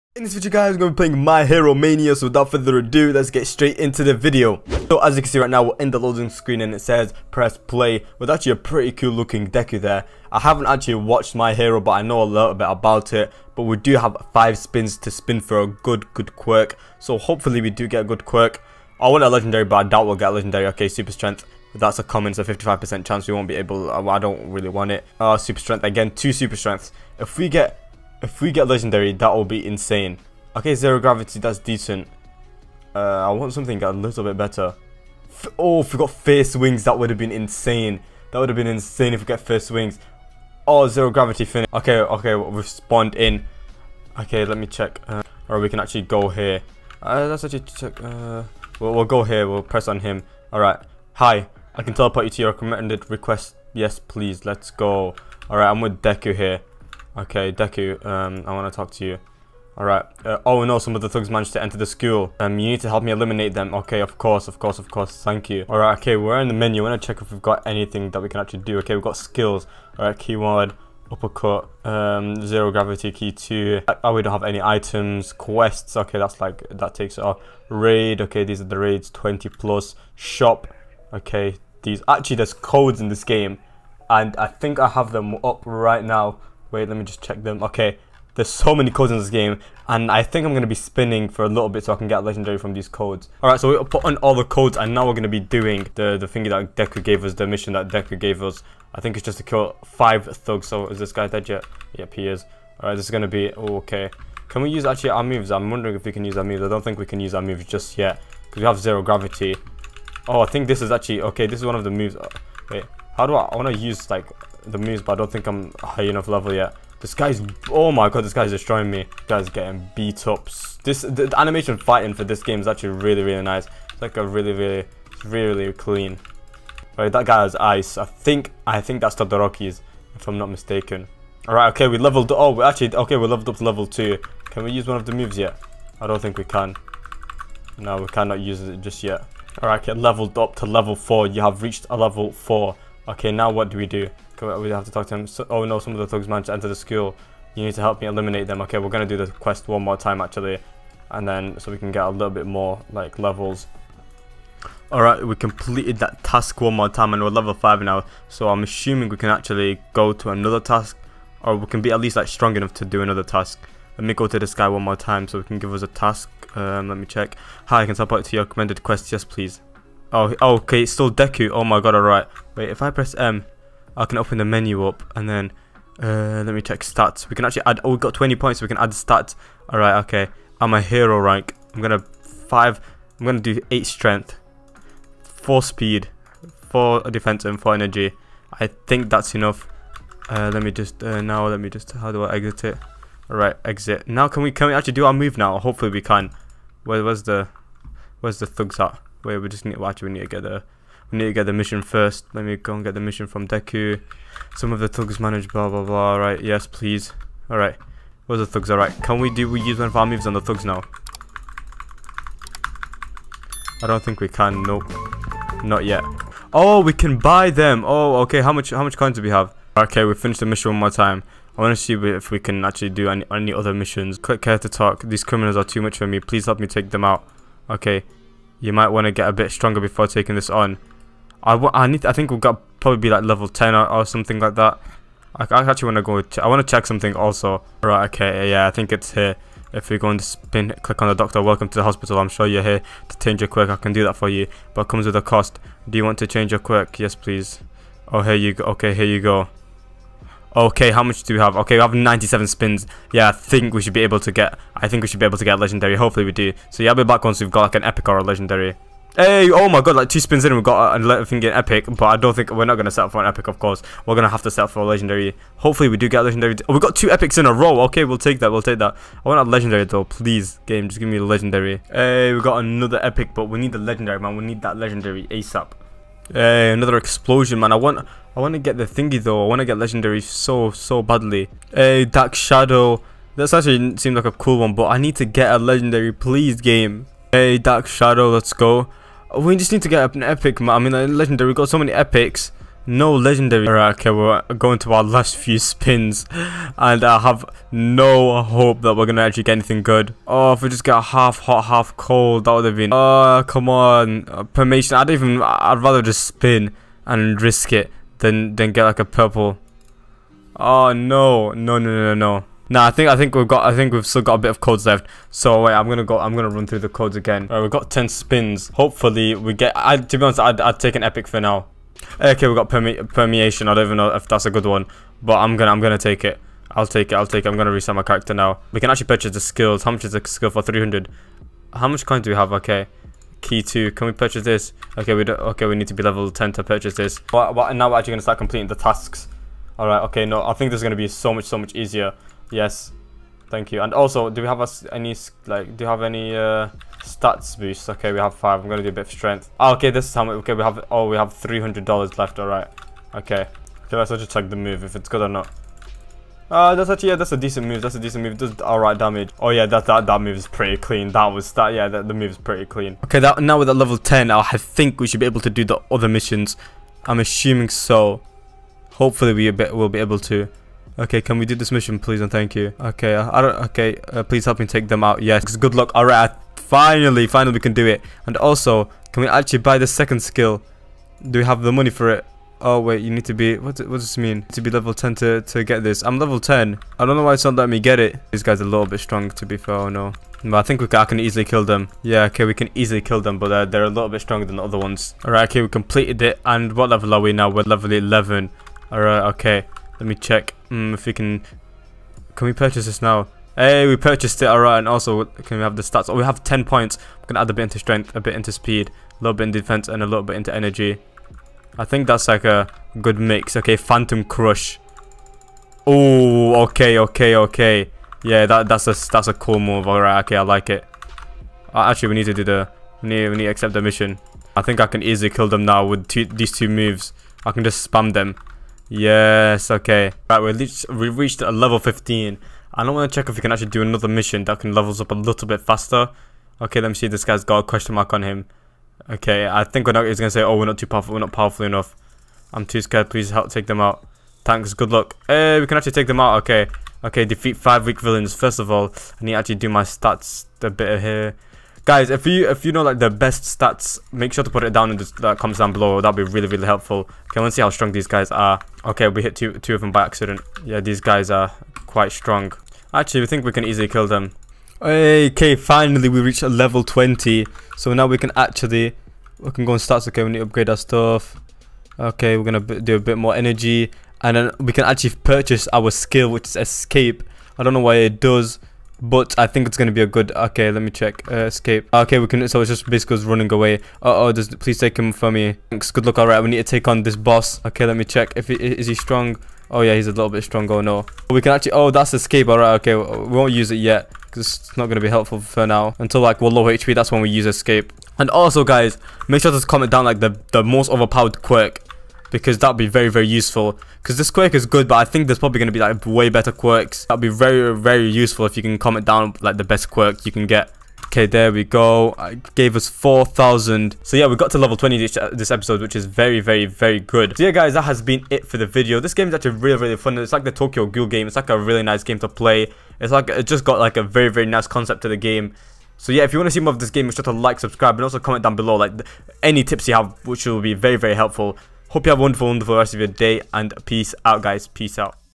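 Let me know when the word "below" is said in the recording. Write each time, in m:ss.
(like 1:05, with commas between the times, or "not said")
7:35, 8:48.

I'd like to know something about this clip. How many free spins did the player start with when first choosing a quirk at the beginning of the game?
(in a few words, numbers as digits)
5.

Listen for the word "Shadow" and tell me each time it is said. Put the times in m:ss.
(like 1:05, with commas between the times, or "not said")
4:42, 4:47.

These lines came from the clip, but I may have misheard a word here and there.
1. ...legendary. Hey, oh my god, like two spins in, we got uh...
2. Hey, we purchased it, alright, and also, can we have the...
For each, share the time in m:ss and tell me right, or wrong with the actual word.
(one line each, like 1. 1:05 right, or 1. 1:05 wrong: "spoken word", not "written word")
1. 4:18 right
2. 6:43 right.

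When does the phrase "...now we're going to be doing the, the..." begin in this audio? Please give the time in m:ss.
1:34.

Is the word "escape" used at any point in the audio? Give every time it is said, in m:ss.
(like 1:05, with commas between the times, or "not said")
7:56, 8:01, 8:12, 8:17.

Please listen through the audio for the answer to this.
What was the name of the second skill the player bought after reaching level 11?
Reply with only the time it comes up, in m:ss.
6:53.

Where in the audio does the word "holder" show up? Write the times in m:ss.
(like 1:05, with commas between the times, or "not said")
not said.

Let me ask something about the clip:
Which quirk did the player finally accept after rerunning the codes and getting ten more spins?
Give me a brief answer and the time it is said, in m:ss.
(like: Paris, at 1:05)
Permeation, at 5:23.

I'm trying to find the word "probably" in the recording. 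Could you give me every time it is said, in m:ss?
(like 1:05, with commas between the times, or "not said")
3:52, 8:25.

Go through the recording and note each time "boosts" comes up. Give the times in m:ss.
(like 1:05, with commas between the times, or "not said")
5:47.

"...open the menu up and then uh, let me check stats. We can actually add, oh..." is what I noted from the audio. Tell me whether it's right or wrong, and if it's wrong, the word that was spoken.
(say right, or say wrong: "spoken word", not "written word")
right.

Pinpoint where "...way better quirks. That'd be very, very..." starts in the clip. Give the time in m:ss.
8:26.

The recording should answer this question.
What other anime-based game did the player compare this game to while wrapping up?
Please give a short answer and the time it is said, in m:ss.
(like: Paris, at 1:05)
Tokyo Ghoul, at 8:40.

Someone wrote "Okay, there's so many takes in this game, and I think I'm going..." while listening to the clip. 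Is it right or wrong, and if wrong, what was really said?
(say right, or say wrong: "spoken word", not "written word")
wrong: "codes", not "takes".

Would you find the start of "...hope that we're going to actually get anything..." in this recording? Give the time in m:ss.
4:58.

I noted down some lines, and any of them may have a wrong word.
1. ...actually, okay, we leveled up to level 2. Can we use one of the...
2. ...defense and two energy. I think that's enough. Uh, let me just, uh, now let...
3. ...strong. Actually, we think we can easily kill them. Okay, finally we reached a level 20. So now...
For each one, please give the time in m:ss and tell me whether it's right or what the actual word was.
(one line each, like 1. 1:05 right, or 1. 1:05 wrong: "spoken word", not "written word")
1. 2:12 right
2. 3:07 wrong: "four", not "two"
3. 7:42 right.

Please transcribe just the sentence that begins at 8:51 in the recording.
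Hope you have a wonderful, wonderful rest of your day and peace out, guys.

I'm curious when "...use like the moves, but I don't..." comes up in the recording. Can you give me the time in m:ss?
1:53.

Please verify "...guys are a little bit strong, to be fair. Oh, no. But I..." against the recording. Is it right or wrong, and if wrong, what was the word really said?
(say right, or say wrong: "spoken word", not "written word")
right.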